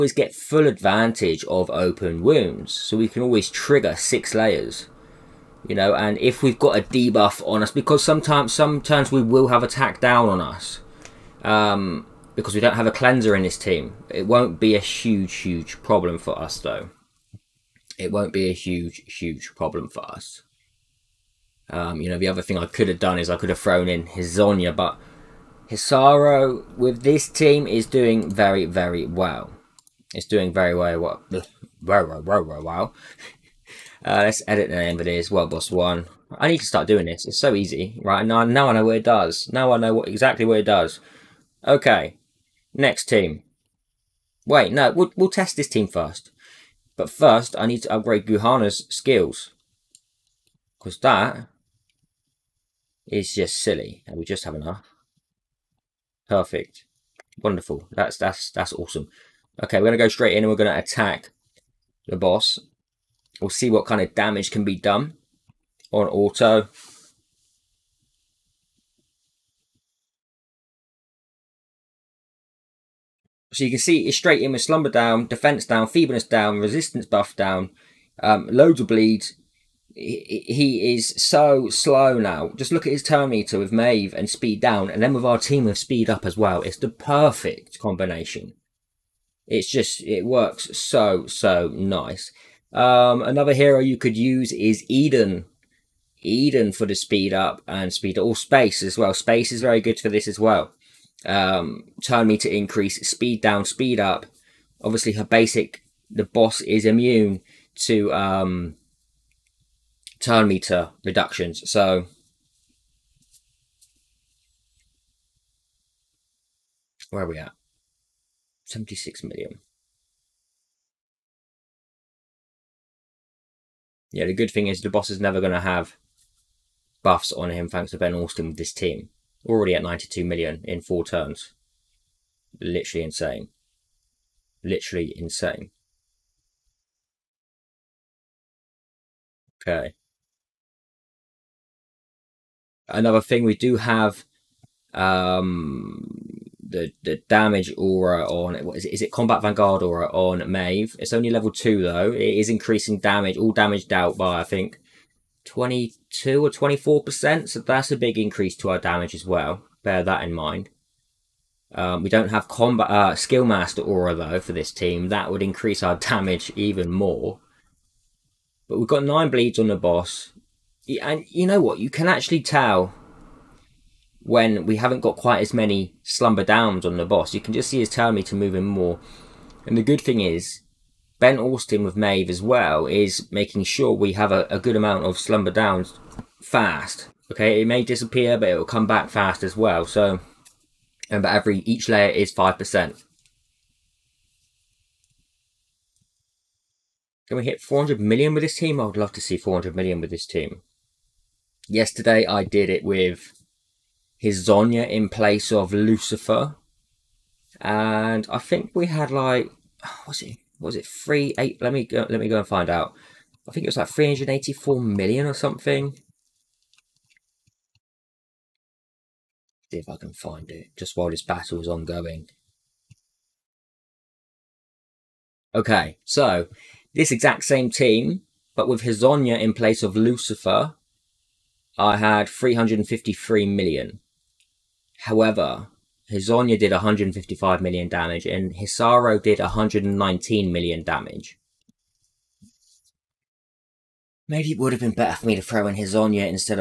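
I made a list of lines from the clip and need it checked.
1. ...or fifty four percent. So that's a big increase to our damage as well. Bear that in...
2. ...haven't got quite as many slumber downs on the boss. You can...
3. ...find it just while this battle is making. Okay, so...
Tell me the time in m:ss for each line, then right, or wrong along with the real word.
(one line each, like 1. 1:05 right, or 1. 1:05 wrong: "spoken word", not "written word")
1. 2:36 wrong: "twenty", not "fifty"
2. 2:54 right
3. 3:40 wrong: "ongoing", not "making".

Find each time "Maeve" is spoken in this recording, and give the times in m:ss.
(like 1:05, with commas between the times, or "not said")
1:23, 2:30, 3:01.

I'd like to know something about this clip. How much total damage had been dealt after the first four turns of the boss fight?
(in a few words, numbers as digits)
92 million.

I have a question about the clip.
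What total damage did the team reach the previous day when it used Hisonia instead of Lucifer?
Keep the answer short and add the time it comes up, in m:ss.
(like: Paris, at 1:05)
353 million, at 3:52.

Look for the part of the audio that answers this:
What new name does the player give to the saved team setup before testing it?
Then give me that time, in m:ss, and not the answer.
0:35.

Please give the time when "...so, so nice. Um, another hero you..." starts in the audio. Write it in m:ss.
1:30.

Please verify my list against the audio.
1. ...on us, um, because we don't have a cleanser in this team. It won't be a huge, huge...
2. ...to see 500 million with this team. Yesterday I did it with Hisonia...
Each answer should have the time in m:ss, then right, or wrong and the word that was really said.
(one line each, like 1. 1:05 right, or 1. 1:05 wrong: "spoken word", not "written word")
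1. 0:10 right
2. 3:19 wrong: "400", not "500".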